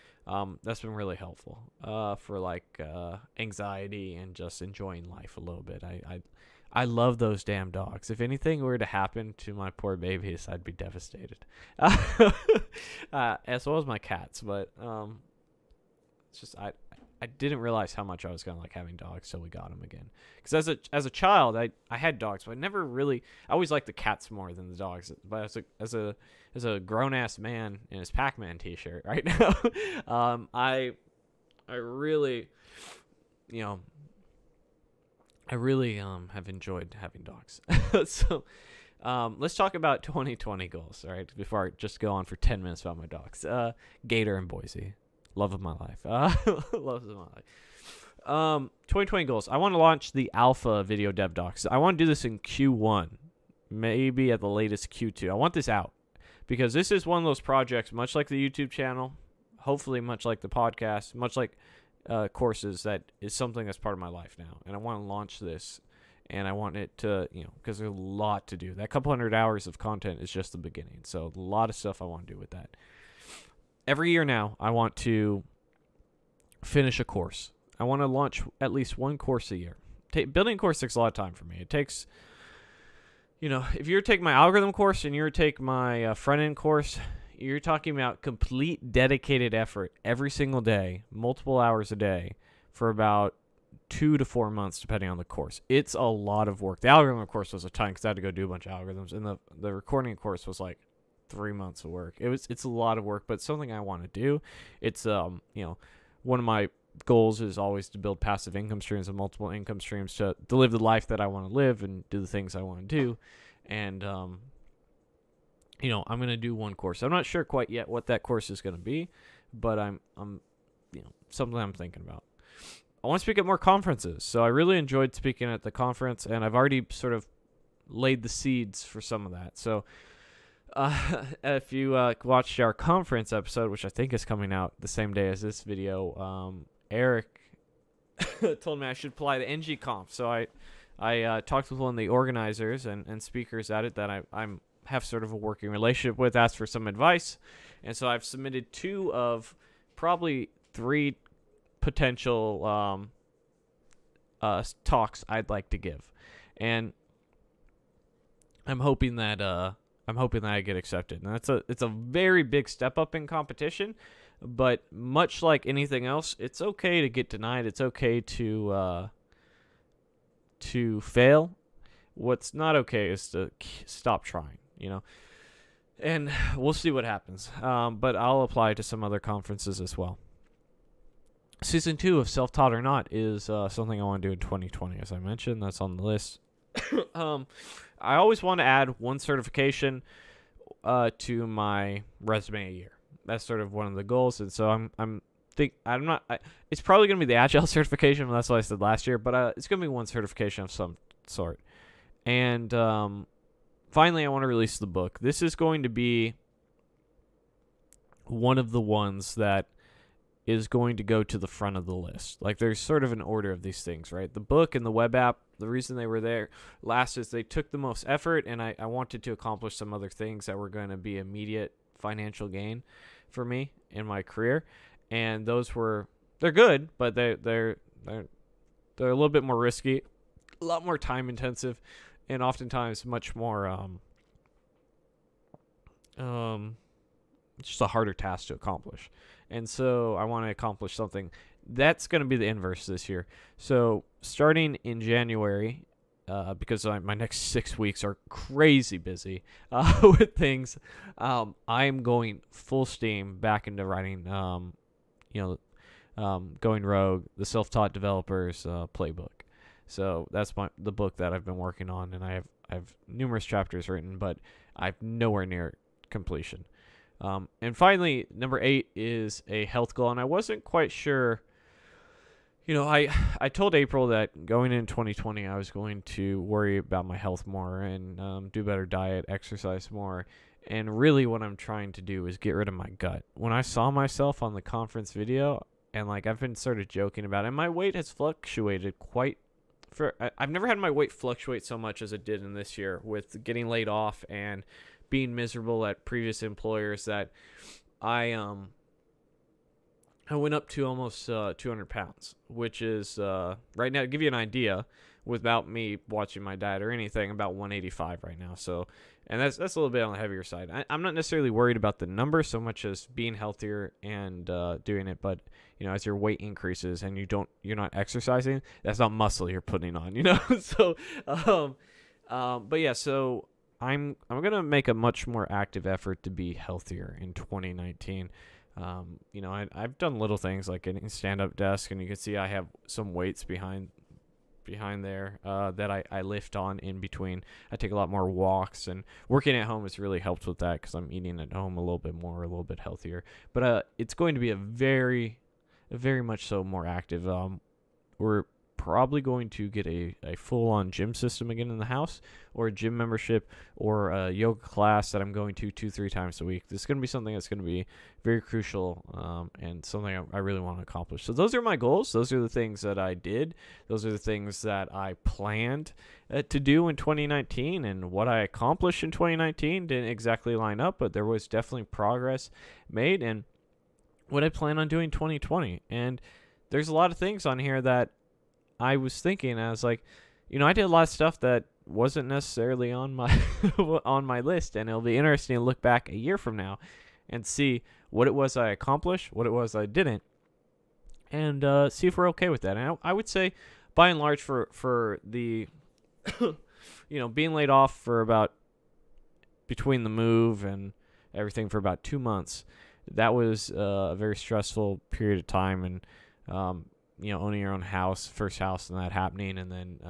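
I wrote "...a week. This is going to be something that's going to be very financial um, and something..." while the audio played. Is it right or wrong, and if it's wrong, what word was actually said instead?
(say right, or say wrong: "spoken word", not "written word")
wrong: "crucial", not "financial".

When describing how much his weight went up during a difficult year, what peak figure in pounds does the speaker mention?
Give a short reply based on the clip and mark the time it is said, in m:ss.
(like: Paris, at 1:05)
200, at 5:01.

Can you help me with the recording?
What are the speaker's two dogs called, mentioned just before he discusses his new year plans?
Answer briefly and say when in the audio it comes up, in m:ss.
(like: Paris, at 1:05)
Gator and Boise, at 0:44.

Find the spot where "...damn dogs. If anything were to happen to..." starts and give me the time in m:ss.
0:07.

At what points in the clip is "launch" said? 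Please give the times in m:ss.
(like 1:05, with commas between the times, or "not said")
0:49, 1:05, 1:18.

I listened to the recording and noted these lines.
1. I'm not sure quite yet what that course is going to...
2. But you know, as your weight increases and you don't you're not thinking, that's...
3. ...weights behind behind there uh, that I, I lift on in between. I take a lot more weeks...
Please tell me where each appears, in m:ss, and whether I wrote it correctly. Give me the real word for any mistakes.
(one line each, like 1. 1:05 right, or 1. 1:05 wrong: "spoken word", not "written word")
1. 1:57 right
2. 5:15 wrong: "exercising", not "thinking"
3. 5:33 wrong: "walks", not "weeks".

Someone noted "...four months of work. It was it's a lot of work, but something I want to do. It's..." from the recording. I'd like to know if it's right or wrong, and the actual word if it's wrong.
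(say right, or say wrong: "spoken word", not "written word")
wrong: "three", not "four".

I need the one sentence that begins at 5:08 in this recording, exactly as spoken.
So, and that's that's a little bit on the heavier side.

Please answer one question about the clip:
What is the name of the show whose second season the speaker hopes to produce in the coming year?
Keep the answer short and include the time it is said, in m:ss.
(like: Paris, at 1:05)
Self Taught or Not, at 3:02.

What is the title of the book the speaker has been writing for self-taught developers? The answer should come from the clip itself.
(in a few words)
Going Rogue.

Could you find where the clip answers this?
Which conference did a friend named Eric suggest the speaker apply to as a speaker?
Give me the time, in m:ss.
2:19.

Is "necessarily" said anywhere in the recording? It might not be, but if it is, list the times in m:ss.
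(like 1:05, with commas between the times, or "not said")
5:11, 6:22.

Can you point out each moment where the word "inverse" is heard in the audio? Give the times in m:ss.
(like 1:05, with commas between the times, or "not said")
4:02.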